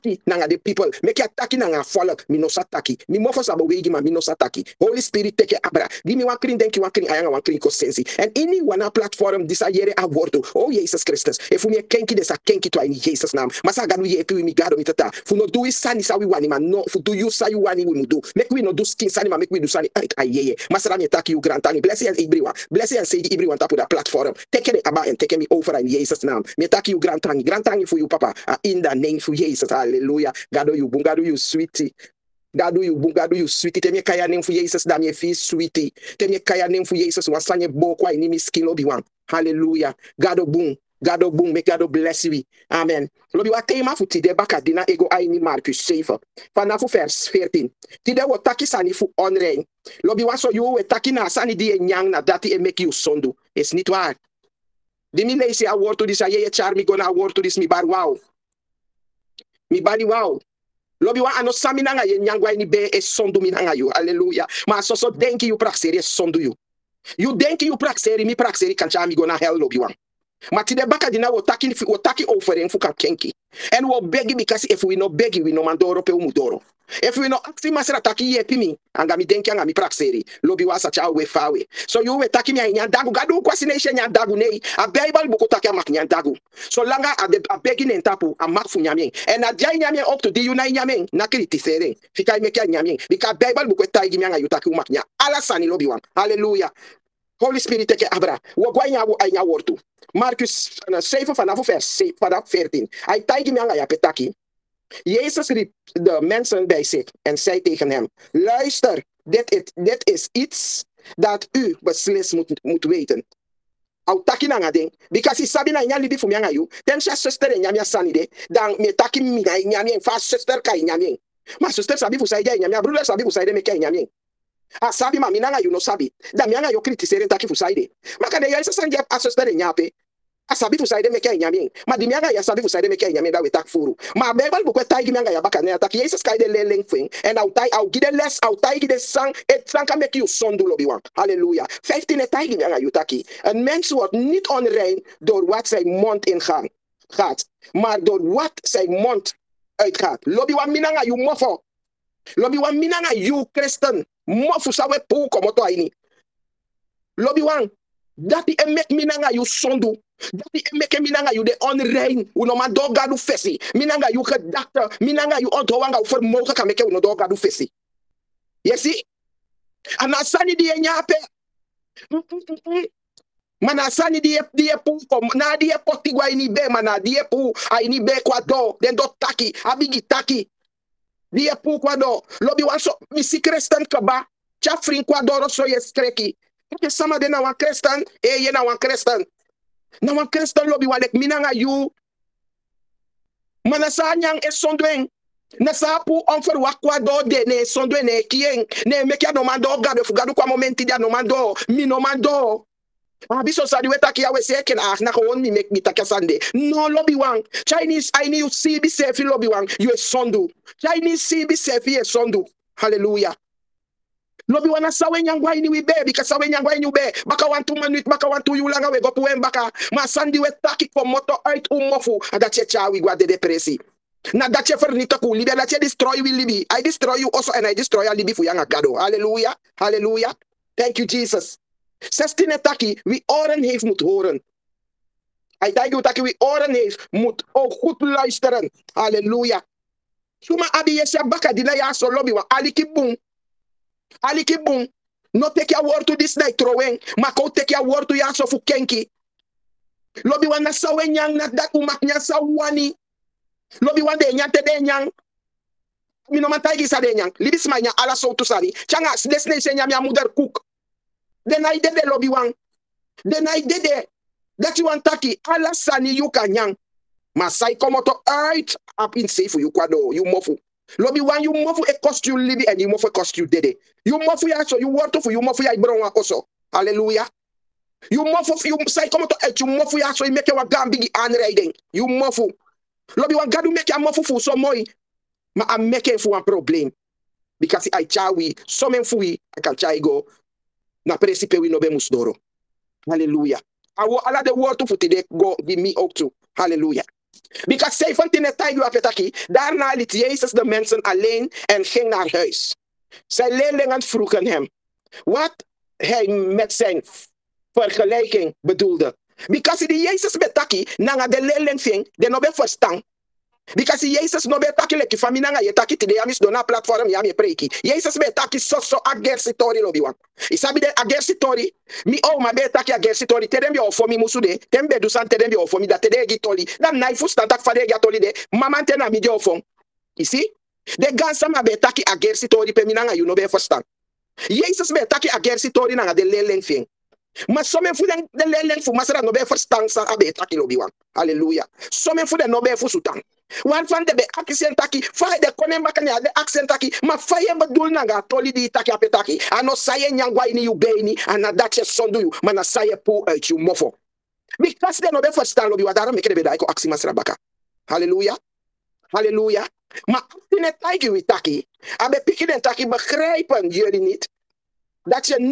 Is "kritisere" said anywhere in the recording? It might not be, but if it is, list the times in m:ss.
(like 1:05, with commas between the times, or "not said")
2:06.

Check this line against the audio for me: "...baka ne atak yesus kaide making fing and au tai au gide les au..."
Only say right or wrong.
wrong.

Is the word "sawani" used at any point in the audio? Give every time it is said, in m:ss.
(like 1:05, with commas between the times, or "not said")
4:12.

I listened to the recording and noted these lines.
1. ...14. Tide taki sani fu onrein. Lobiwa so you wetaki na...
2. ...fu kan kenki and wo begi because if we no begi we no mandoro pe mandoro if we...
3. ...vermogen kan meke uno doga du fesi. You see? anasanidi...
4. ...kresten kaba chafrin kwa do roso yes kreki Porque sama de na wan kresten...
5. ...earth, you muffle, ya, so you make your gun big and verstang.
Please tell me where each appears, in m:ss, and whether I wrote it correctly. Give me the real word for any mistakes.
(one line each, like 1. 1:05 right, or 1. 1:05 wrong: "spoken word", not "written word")
1. 0:47 right
2. 1:12 wrong: "umudoro", not "mandoro"
3. 2:46 right
4. 3:03 right
5. 4:39 wrong: "riding", not "verstang".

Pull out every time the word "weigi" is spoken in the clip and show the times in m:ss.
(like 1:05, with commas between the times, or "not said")
0:03.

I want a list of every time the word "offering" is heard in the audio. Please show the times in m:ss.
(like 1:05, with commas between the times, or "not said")
1:12.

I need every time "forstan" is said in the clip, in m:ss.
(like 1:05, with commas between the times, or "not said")
5:33.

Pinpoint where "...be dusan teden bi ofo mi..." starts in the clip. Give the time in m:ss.
5:24.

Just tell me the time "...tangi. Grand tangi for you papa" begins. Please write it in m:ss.
0:27.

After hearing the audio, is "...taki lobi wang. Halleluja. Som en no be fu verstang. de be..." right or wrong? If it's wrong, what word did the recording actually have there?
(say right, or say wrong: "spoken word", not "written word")
wrong: "sutang", not "verstang".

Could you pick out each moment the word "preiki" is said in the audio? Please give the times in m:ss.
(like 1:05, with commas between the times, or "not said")
5:17.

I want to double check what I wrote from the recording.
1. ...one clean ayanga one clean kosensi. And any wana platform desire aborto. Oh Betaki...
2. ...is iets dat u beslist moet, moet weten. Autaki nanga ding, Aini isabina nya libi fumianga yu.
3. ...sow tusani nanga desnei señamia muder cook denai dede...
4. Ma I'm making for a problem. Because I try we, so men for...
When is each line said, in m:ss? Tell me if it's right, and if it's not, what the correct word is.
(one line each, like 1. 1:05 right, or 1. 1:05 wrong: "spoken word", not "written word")
1. 0:06 wrong: "Jesus", not "Betaki"
2. 1:50 wrong: "Because", not "Aini"
3. 4:18 wrong: "canga", not "nanga"
4. 4:45 right.